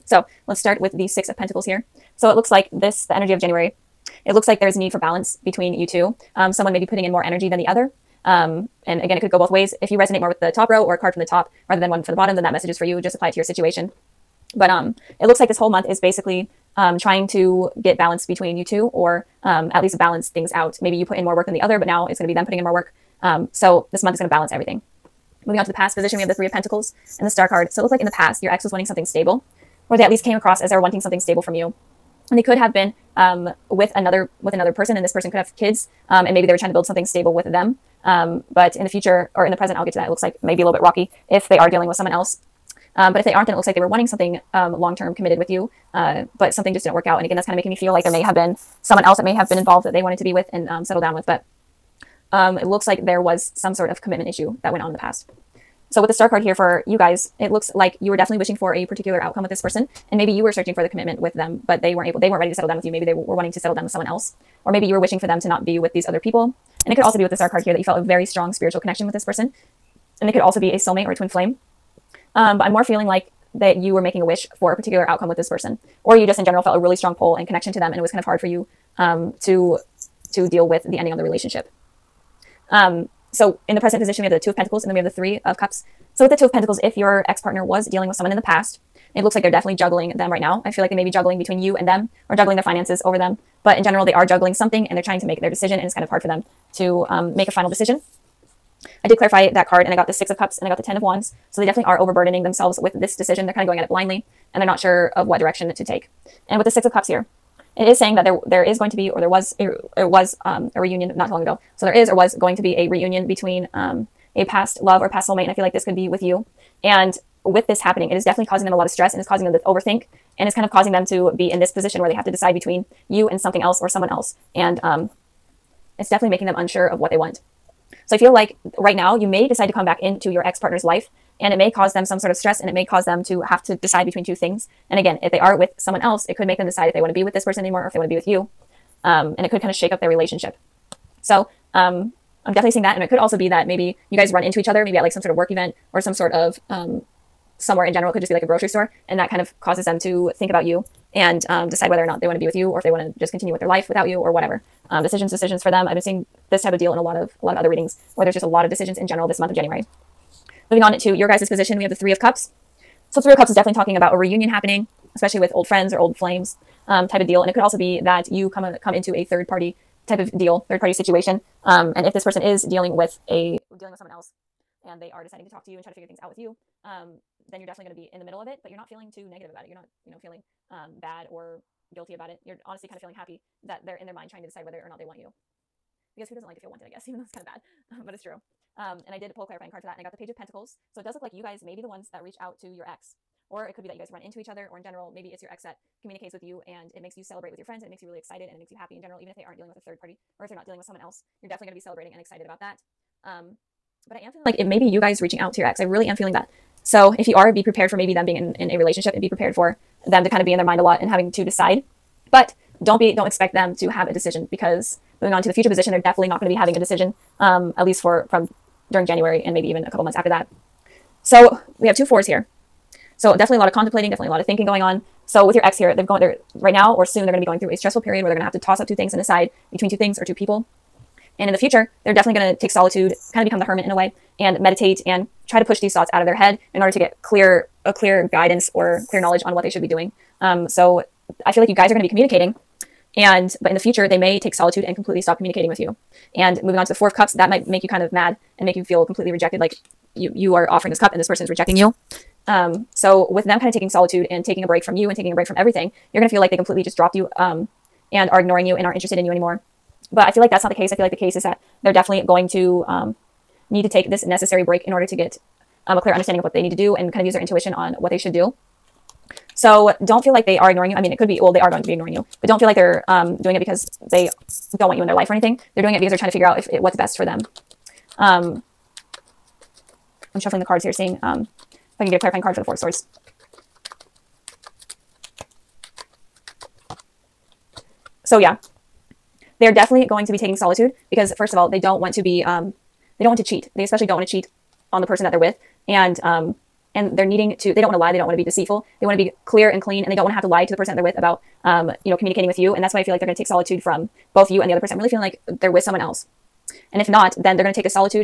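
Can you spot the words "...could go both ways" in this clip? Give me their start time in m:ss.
0:09.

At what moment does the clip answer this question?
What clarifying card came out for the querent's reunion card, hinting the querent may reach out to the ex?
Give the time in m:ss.
3:10.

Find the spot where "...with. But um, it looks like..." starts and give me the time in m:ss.
0:51.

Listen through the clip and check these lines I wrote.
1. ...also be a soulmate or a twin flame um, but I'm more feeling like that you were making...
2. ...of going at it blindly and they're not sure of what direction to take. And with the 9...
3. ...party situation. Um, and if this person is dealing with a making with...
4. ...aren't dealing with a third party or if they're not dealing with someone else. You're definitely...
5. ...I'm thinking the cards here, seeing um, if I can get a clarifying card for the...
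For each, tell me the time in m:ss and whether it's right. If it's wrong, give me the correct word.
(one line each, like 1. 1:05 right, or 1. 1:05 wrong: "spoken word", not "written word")
1. 1:10 right
2. 1:43 wrong: "6", not "9"
3. 2:50 wrong: "dealing", not "making"
4. 3:19 right
5. 4:40 wrong: "shuffling", not "thinking".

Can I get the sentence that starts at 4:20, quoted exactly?
But I feel like that's not the case.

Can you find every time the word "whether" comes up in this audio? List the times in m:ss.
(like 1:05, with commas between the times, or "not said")
2:31, 3:04.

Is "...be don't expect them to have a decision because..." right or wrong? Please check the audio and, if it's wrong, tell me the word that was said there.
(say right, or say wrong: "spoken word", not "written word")
right.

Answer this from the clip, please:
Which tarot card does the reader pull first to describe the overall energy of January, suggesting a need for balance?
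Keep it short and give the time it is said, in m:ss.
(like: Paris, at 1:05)
Six of Pentacles, at 0:01.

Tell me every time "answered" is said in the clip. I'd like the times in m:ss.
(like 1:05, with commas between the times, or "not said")
not said.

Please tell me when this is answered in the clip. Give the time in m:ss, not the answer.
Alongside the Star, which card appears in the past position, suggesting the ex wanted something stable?
0:26.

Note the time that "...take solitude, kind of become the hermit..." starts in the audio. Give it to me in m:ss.
3:52.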